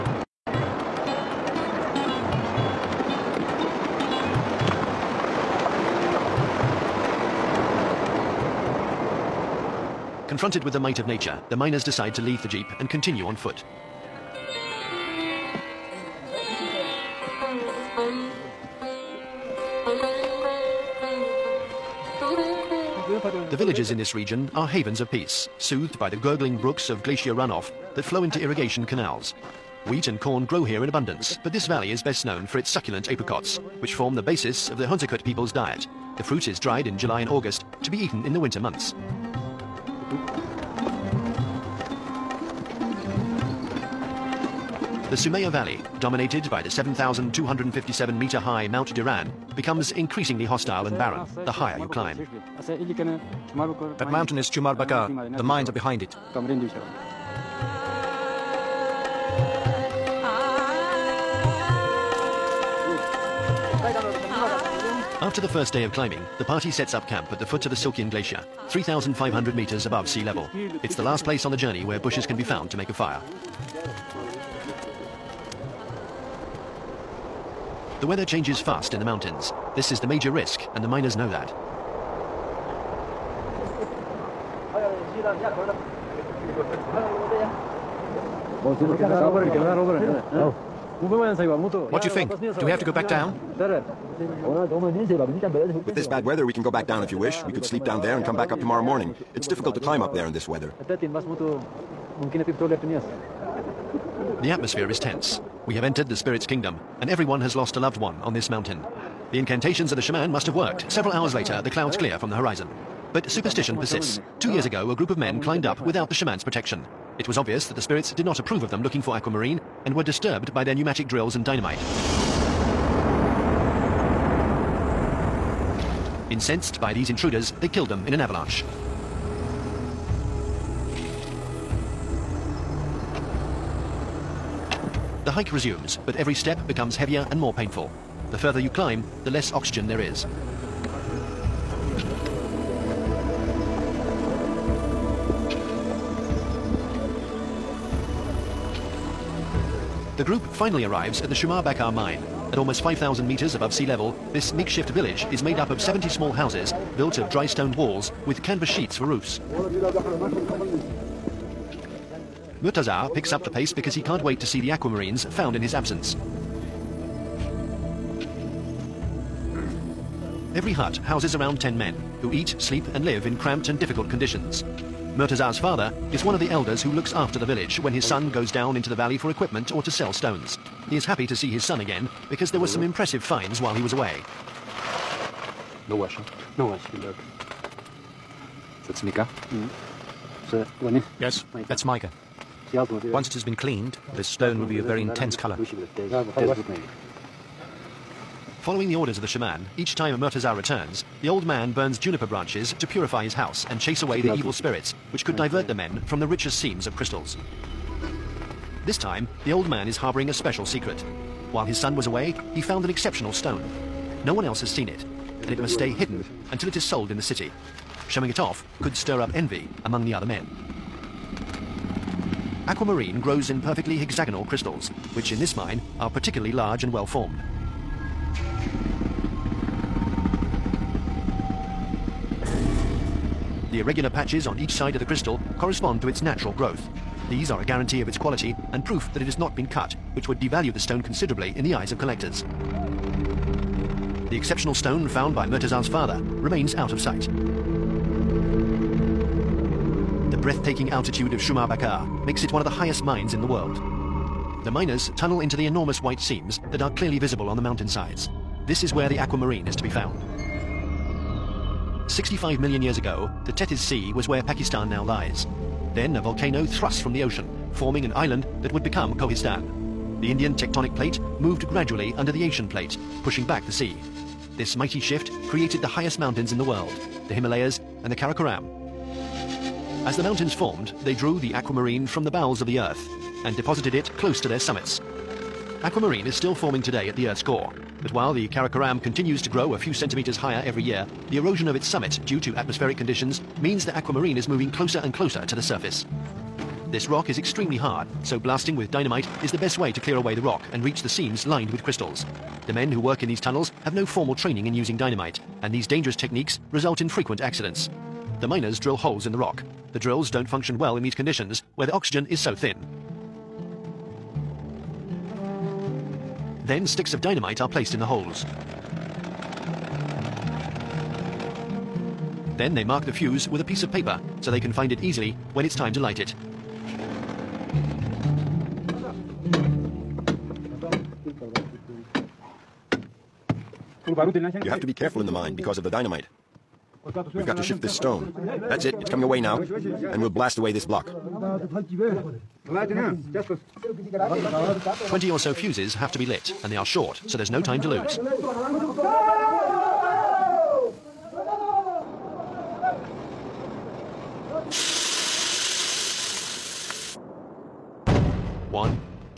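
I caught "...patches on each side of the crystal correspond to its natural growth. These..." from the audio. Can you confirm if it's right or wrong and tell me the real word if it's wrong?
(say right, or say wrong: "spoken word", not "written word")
right.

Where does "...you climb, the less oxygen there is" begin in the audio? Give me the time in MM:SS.
02:18.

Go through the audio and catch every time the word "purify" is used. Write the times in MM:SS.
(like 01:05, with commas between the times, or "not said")
03:22.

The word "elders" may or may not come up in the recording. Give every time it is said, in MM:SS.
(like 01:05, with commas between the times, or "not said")
02:56.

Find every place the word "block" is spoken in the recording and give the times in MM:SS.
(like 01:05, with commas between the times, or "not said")
05:40.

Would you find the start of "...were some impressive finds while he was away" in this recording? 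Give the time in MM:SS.
03:02.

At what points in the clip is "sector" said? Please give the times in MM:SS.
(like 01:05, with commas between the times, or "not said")
not said.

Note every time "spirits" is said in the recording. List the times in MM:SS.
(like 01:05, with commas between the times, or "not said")
01:46, 01:57, 03:24.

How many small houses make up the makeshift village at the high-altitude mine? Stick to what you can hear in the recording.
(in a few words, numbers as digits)
70.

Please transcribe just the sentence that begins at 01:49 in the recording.
The incantations of the shaman must have worked.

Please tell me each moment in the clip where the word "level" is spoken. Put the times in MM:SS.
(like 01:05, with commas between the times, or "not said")
01:10, 02:33.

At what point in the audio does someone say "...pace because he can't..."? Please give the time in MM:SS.
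02:43.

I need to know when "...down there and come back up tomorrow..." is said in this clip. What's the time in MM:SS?
01:37.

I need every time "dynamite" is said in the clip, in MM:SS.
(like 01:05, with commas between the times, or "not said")
02:01, 04:58, 05:04, 05:17, 05:35.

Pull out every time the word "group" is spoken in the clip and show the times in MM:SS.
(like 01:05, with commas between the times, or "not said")
01:54, 02:30.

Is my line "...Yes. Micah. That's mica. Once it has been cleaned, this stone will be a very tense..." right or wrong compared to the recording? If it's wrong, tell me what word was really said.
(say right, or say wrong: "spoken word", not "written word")
wrong: "intense", not "tense".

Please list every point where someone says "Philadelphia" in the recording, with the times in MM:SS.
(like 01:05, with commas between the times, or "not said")
not said.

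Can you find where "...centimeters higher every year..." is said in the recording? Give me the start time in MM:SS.
04:49.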